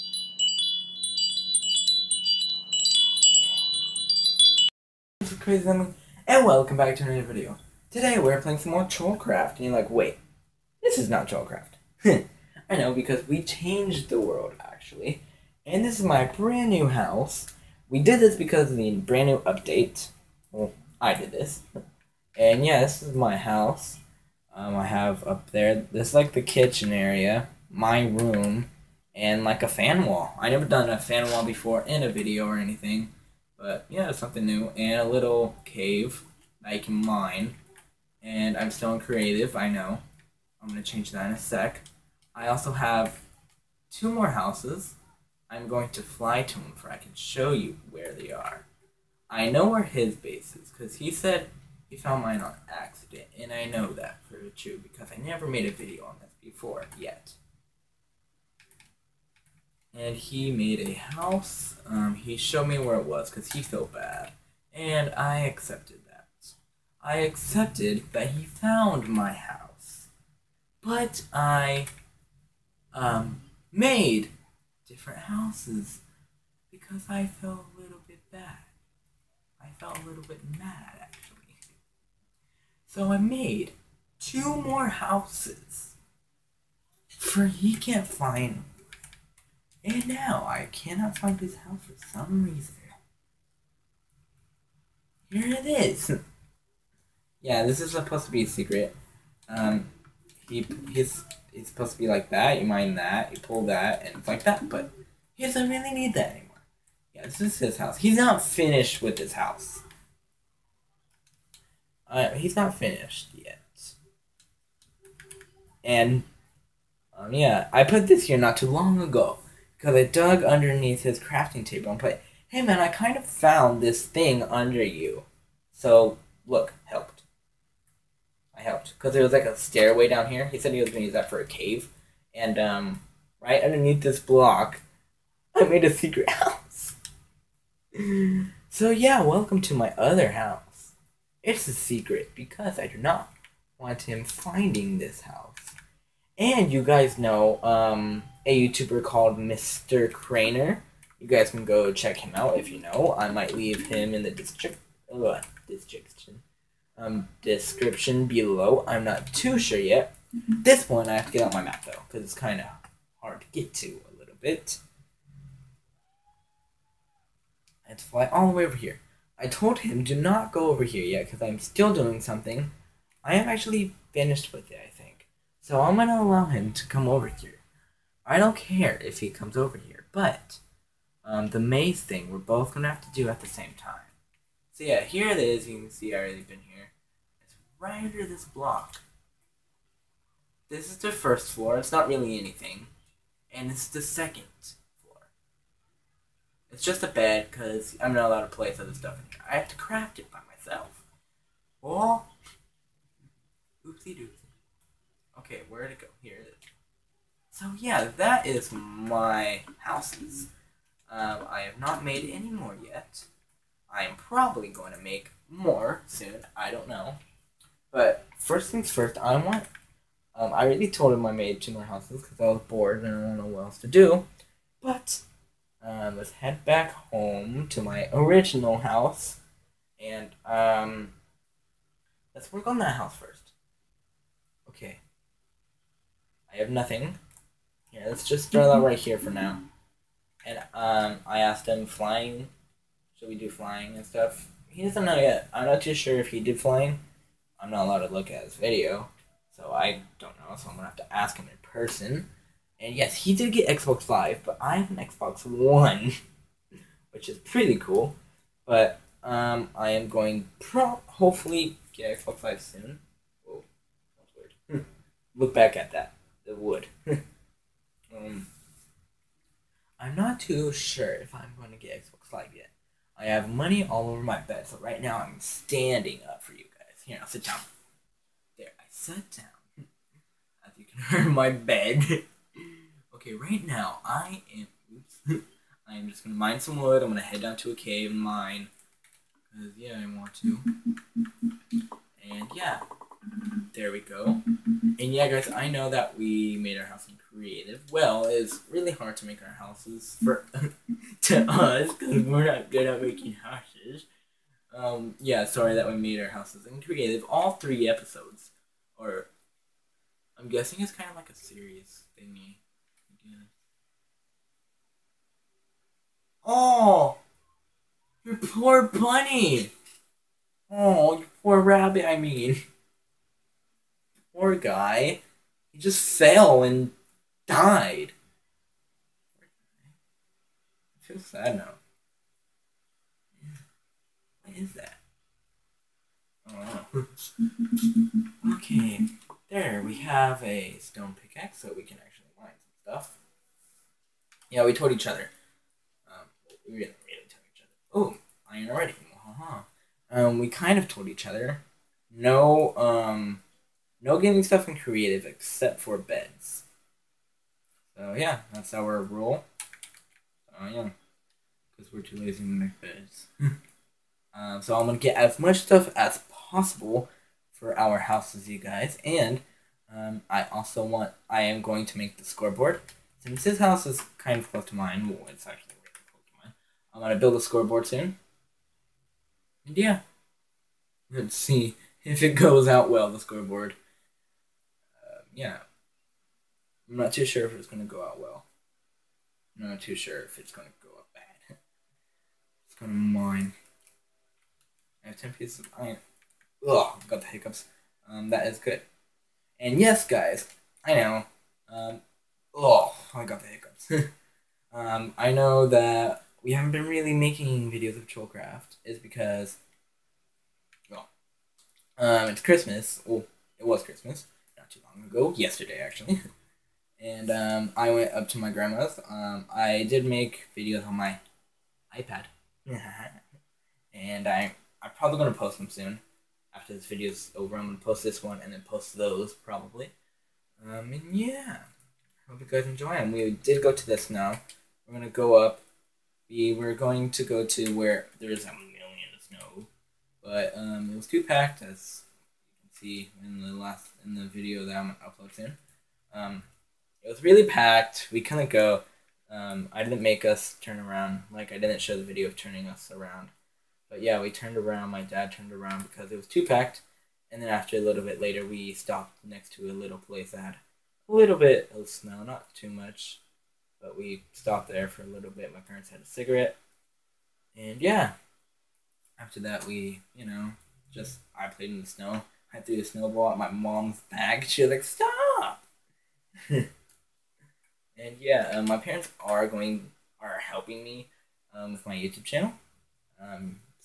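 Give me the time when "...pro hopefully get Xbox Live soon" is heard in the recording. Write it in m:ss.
4:20.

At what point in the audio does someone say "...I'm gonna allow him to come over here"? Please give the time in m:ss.
2:55.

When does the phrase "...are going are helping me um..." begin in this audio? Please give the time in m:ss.
7:59.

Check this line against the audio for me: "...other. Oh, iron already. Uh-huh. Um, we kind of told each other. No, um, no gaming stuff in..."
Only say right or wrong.
right.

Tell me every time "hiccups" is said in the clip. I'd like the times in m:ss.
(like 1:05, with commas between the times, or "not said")
6:37, 6:43.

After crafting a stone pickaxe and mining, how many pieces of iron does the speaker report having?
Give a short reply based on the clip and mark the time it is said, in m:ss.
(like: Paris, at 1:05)
10, at 6:35.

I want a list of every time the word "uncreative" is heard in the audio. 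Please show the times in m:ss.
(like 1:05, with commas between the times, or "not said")
5:06.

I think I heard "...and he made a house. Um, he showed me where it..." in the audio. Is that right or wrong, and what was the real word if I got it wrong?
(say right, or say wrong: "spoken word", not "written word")
right.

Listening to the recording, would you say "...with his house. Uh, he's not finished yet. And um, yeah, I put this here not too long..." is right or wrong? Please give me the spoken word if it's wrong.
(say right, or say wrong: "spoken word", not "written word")
right.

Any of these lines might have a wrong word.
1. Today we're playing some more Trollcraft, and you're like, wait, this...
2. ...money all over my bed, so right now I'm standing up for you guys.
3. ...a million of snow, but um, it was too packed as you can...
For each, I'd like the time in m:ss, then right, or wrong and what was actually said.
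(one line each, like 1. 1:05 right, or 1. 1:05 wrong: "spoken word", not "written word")
1. 0:07 right
2. 4:33 right
3. 7:18 right.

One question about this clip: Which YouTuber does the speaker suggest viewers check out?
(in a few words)
Mr. Craner.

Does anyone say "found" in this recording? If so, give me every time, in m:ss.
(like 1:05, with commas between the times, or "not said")
0:51, 1:08, 2:03.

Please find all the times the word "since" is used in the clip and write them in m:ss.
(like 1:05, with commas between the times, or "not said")
6:13.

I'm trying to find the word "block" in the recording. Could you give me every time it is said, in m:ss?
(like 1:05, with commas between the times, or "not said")
2:14, 3:08.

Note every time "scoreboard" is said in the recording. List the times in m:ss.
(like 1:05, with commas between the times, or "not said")
6:12, 6:17, 6:23.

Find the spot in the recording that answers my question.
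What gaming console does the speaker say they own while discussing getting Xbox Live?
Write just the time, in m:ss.
4:15.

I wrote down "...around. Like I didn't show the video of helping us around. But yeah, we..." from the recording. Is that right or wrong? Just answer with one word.
wrong.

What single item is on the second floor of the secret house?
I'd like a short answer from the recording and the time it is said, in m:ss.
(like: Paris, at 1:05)
A bed, at 3:16.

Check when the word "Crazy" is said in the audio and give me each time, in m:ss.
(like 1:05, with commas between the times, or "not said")
0:05.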